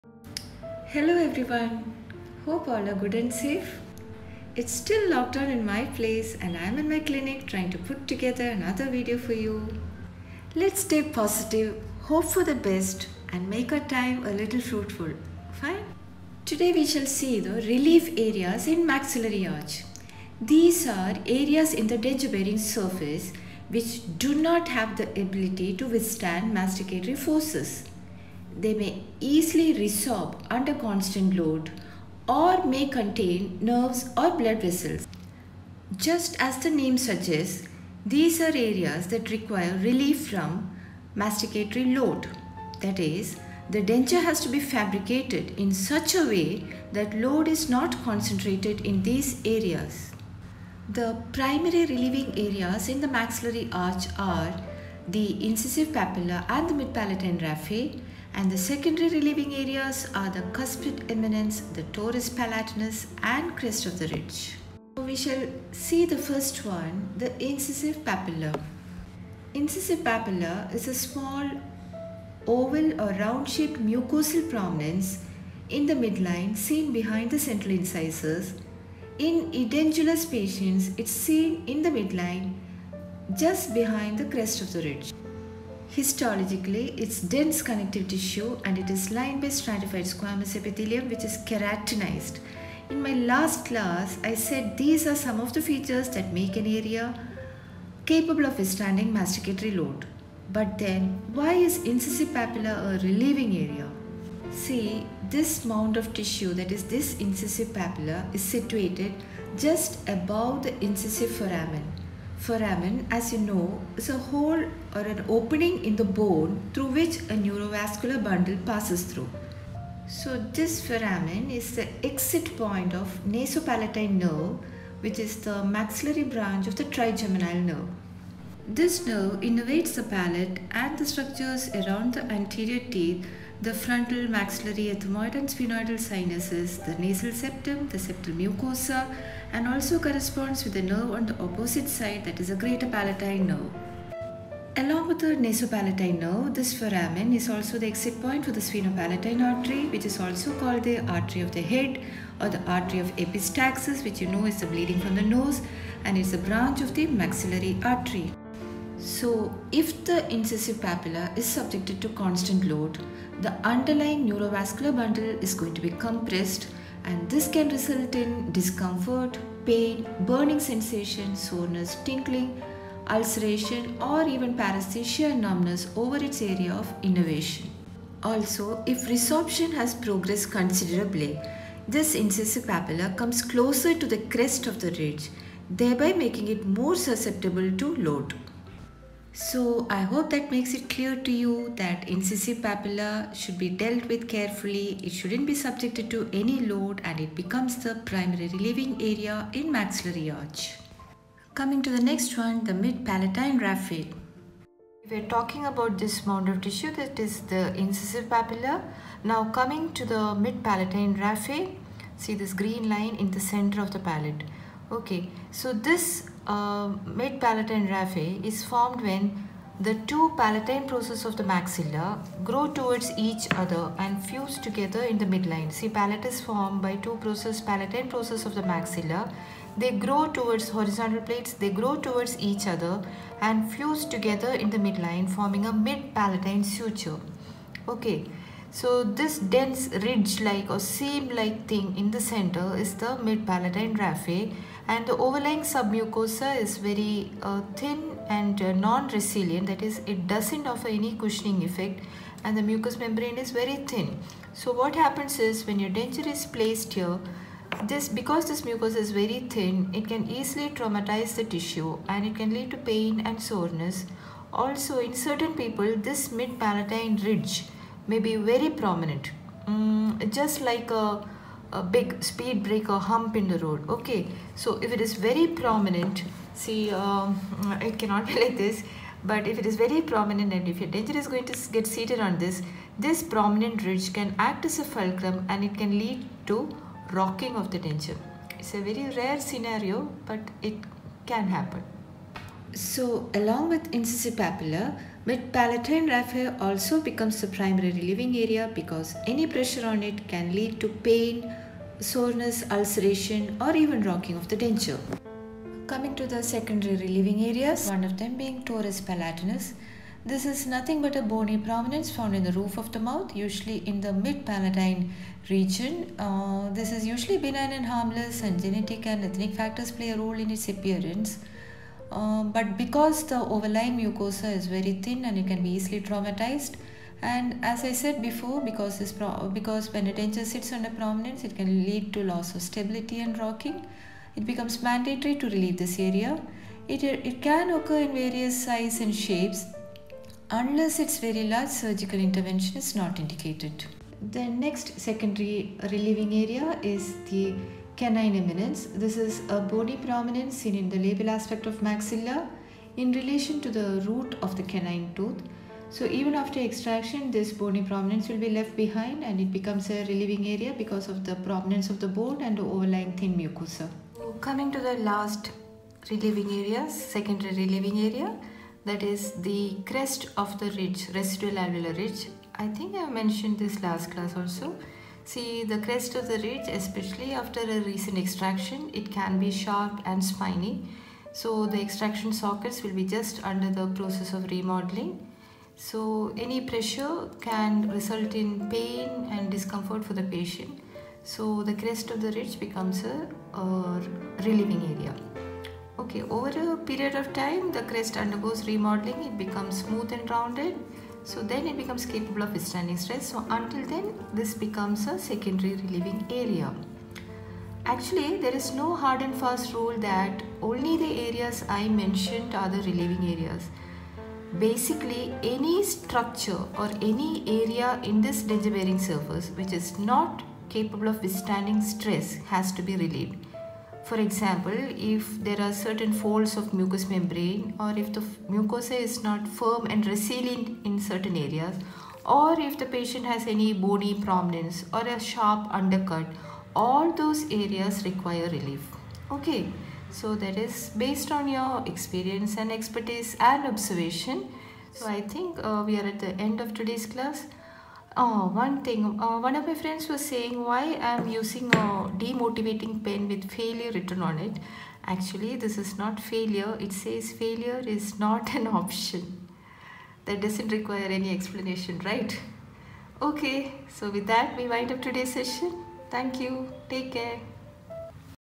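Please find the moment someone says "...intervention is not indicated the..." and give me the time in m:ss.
5:42.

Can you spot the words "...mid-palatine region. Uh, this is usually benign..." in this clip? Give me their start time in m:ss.
5:14.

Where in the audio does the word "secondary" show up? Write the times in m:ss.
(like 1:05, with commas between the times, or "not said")
0:58, 5:06, 5:44, 6:06, 6:45.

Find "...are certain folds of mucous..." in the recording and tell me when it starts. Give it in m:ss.
7:05.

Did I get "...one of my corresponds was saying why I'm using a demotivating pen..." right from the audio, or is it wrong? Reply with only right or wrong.
wrong.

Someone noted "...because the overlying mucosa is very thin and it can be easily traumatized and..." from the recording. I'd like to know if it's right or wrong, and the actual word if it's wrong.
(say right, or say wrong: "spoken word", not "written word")
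right.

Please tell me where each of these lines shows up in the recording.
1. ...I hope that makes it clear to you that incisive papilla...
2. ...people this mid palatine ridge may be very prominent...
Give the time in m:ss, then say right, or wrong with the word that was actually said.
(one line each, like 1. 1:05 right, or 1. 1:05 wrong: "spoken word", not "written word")
1. 3:09 right
2. 4:25 right.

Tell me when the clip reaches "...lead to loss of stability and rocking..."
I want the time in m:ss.
5:31.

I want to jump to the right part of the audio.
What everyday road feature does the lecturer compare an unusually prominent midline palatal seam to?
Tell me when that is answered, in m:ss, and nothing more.
4:32.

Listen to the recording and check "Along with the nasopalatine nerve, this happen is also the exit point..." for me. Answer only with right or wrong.
wrong.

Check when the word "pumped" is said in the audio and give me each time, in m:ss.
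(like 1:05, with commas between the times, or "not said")
not said.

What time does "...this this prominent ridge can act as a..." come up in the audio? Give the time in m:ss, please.
4:42.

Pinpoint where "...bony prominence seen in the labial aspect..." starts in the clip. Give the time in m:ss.
5:49.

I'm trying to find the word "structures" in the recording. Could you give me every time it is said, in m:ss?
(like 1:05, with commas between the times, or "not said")
2:11, 6:55.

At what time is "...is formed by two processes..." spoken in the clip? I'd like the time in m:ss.
3:46.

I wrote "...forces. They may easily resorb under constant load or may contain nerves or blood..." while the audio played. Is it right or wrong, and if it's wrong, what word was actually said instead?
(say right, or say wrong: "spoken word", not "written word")
right.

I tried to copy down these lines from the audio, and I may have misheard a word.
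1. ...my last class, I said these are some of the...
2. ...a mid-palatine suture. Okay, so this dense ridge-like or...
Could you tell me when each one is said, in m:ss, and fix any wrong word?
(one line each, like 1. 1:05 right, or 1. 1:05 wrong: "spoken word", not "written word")
1. 1:33 right
2. 3:55 right.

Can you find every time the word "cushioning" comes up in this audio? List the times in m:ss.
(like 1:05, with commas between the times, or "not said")
4:11.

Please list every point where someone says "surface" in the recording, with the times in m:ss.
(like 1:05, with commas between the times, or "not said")
0:22, 6:58.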